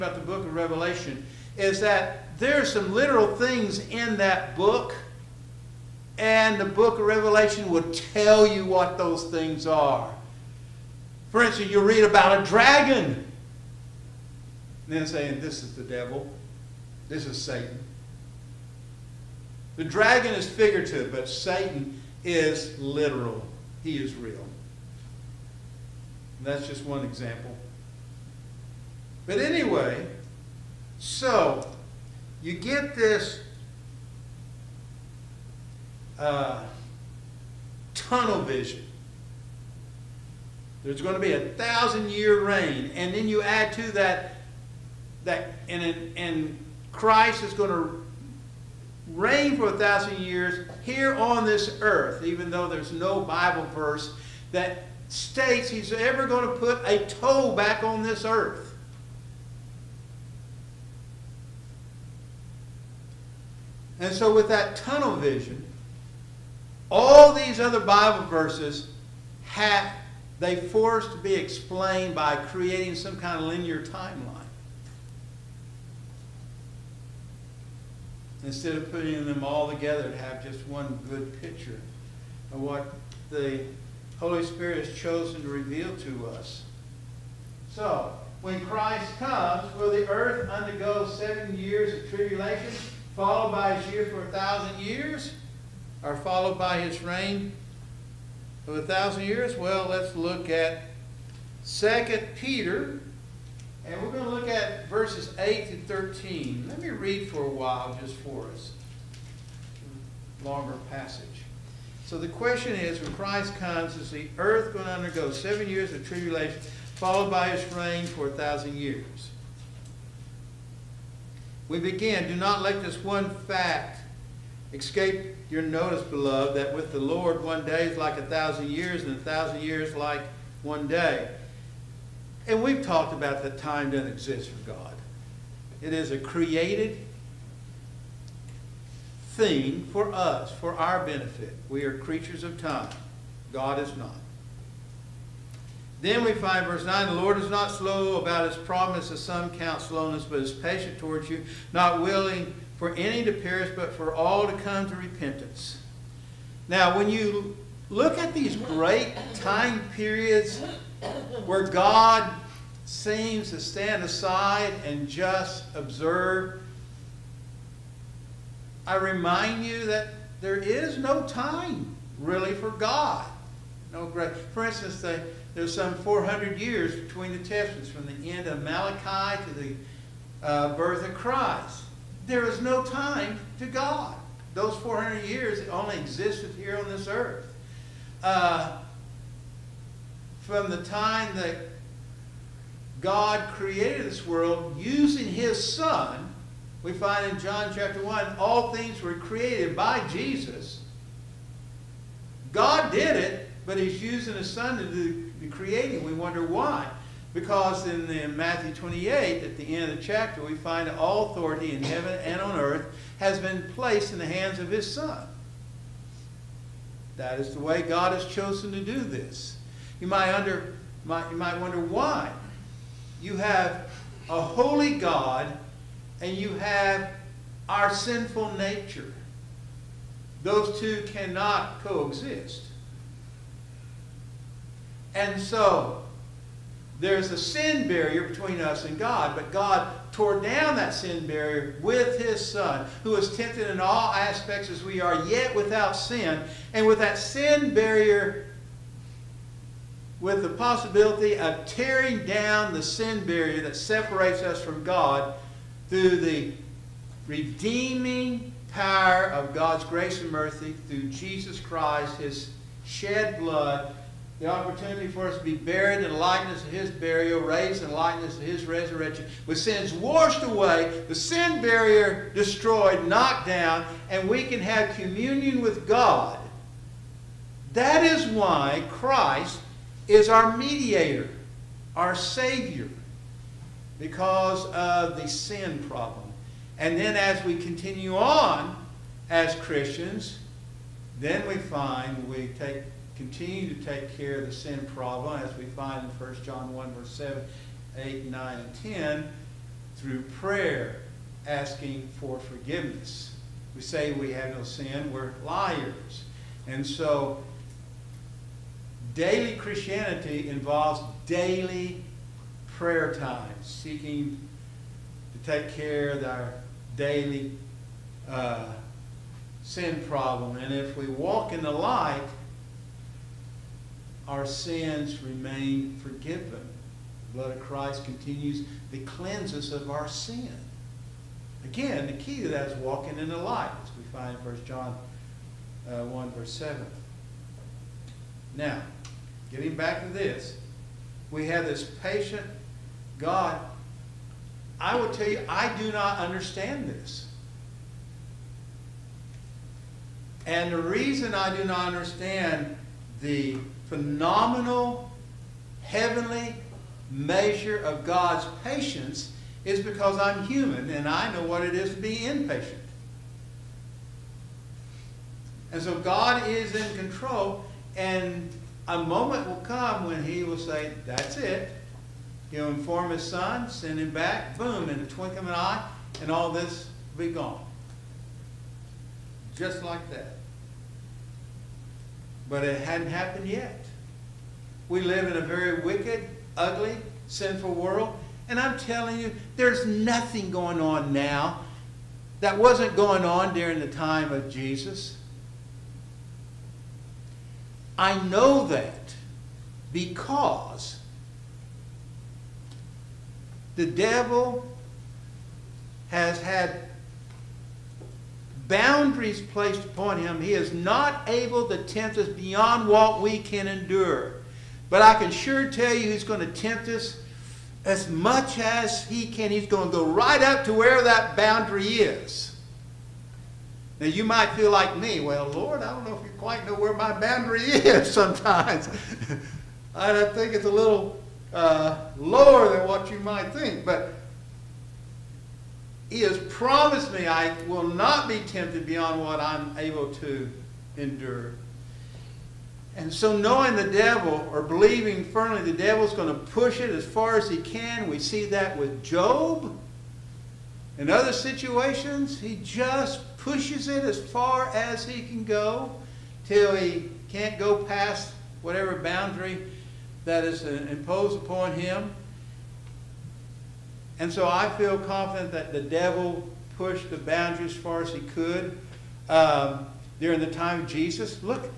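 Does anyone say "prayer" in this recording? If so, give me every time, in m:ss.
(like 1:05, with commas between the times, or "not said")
5:00, 5:12.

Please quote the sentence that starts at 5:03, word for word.
We say we have no sin, we're liars.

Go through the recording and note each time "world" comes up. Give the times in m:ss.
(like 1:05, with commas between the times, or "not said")
3:14, 6:27.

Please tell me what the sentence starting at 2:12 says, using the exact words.
And we've talked about that time doesn't exist for God.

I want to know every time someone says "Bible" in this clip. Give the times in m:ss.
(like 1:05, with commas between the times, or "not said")
0:53, 1:07.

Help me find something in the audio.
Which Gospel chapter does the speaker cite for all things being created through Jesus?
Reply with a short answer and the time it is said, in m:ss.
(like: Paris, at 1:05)
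John chapter 1, at 3:17.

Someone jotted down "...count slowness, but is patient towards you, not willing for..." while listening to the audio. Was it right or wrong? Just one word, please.
right.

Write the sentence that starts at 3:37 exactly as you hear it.
That is the way God has chosen to do this.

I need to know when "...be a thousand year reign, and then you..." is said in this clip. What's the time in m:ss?
0:41.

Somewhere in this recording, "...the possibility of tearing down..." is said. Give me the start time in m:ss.
4:10.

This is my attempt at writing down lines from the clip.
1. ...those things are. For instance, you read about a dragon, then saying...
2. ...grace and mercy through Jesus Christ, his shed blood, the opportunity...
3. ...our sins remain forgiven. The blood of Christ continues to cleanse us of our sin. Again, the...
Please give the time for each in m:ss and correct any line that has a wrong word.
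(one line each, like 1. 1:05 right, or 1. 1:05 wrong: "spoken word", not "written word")
1. 0:08 right
2. 4:19 right
3. 5:24 right.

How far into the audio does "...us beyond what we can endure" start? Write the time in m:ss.
6:52.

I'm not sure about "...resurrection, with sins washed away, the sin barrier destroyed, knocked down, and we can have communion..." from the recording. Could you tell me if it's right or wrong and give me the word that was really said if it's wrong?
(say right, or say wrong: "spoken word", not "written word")
right.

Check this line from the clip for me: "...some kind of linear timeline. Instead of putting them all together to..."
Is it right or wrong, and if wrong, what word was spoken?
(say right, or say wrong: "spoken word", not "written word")
right.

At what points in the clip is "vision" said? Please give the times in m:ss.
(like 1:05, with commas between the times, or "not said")
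0:38, 1:05.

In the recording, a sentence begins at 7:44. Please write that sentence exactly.
And so I feel confident that the devil pushed the boundary as far as he could um, during the time of Jesus.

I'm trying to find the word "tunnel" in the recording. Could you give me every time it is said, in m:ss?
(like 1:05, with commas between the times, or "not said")
0:37, 1:04.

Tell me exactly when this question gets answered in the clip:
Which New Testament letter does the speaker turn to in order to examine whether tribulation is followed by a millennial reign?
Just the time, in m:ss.
1:41.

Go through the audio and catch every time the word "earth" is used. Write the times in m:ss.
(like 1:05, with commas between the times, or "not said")
0:51, 0:58, 1:30, 1:54, 3:07, 3:32.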